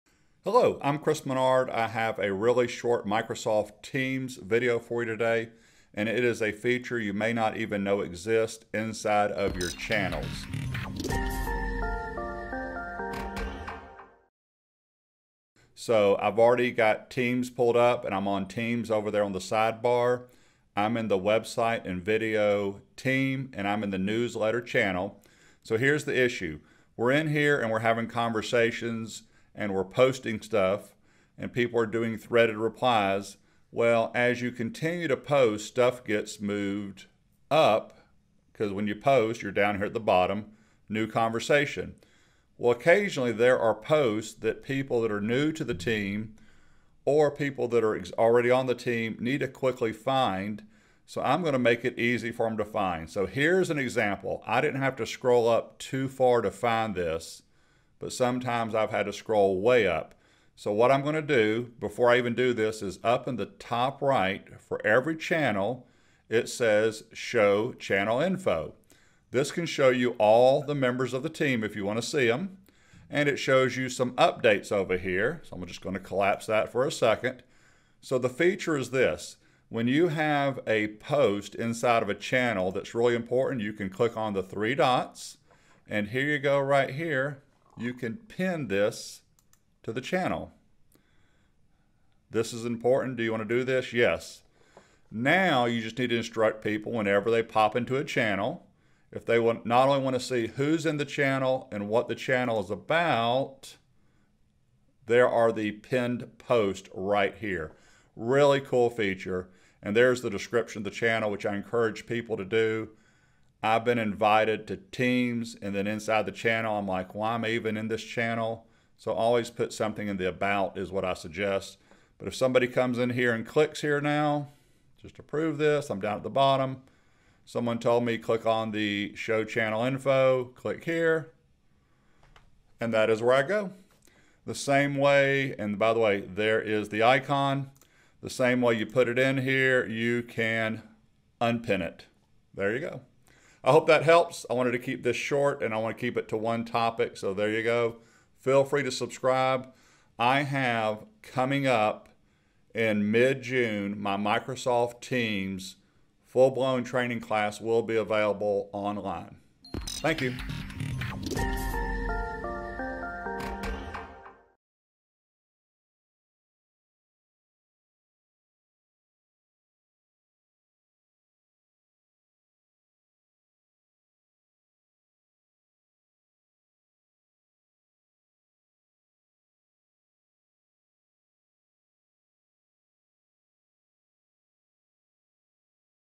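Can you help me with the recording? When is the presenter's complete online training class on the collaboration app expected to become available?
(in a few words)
Mid June.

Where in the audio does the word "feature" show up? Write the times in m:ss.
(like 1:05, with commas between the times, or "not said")
0:06, 1:18, 1:48.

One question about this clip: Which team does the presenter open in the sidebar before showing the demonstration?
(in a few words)
Website and video team.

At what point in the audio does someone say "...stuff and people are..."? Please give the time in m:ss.
0:30.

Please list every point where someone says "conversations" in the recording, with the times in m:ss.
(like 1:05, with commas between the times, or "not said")
0:28, 0:41.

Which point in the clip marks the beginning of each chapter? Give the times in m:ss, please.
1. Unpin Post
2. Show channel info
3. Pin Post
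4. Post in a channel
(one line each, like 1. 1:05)
1. 2:15
2. 1:05
3. 1:25
4. 0:20.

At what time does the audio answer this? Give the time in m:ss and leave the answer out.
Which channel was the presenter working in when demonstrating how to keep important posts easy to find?
0:23.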